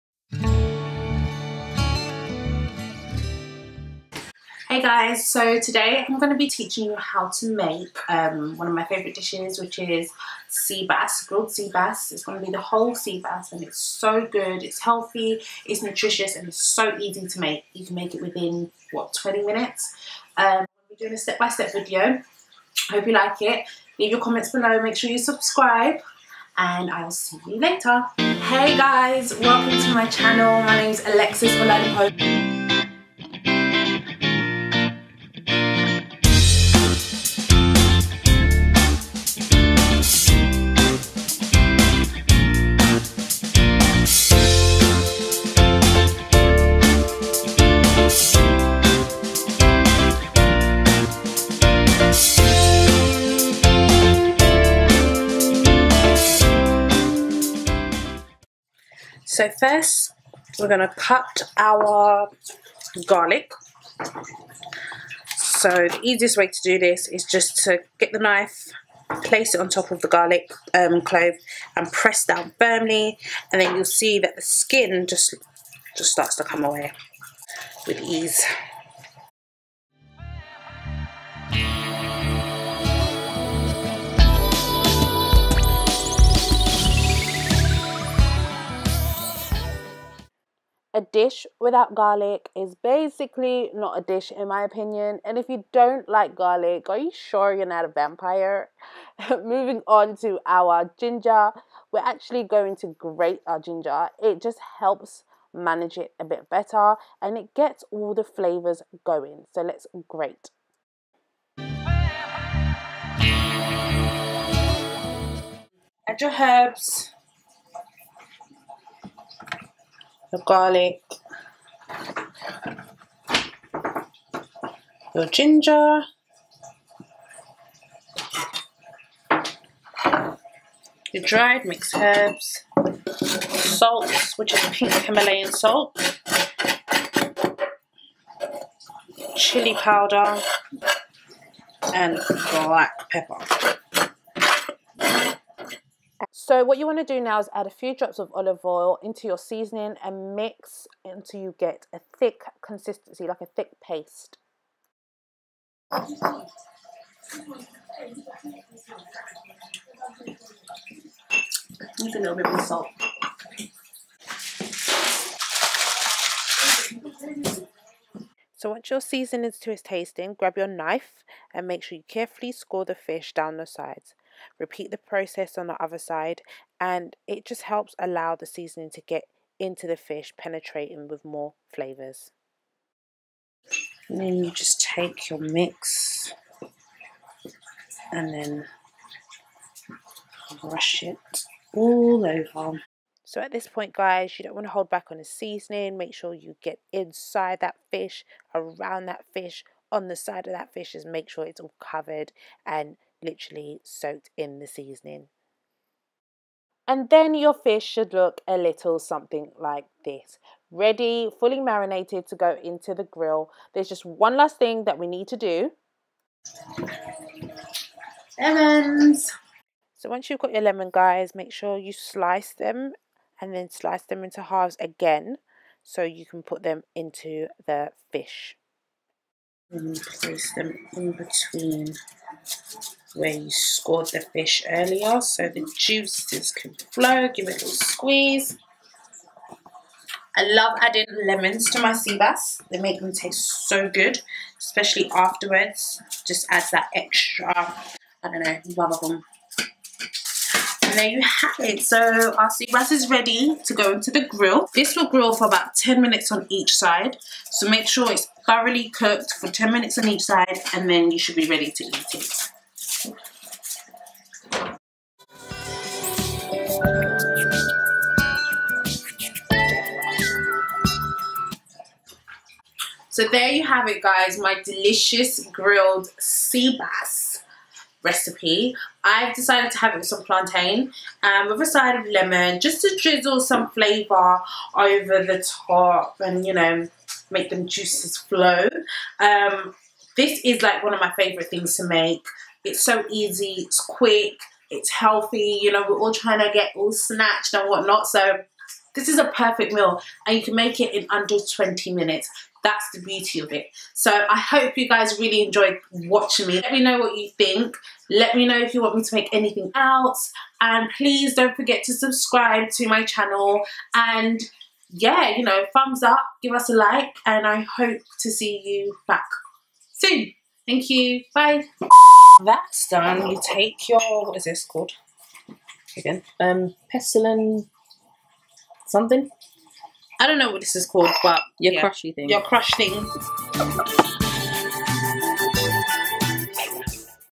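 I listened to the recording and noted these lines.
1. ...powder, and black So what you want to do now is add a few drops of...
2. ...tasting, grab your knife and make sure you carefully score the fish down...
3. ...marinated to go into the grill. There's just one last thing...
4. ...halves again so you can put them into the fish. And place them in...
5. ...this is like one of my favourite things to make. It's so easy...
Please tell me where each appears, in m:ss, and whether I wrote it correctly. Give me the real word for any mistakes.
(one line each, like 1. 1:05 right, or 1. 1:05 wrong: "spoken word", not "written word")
1. 2:19 right
2. 2:49 right
3. 3:31 right
4. 3:44 right
5. 4:50 right.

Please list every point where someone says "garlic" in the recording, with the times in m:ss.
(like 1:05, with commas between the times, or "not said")
1:03, 1:10, 1:31, 1:36, 2:00.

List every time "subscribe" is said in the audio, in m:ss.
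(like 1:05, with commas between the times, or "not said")
0:25, 5:11.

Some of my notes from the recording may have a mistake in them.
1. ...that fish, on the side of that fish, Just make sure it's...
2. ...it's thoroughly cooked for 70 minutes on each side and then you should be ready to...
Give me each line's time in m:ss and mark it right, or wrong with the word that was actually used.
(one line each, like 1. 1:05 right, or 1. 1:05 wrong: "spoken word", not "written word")
1. 3:19 right
2. 4:18 wrong: "10", not "70".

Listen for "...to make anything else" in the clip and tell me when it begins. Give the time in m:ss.
5:09.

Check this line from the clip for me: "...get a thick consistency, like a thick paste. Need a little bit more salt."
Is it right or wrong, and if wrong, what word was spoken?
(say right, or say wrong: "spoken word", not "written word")
right.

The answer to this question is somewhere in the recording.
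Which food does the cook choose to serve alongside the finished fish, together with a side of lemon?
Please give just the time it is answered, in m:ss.
4:40.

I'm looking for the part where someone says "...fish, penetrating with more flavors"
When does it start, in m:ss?
2:59.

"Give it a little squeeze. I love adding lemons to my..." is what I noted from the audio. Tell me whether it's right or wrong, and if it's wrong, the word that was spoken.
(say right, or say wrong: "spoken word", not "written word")
right.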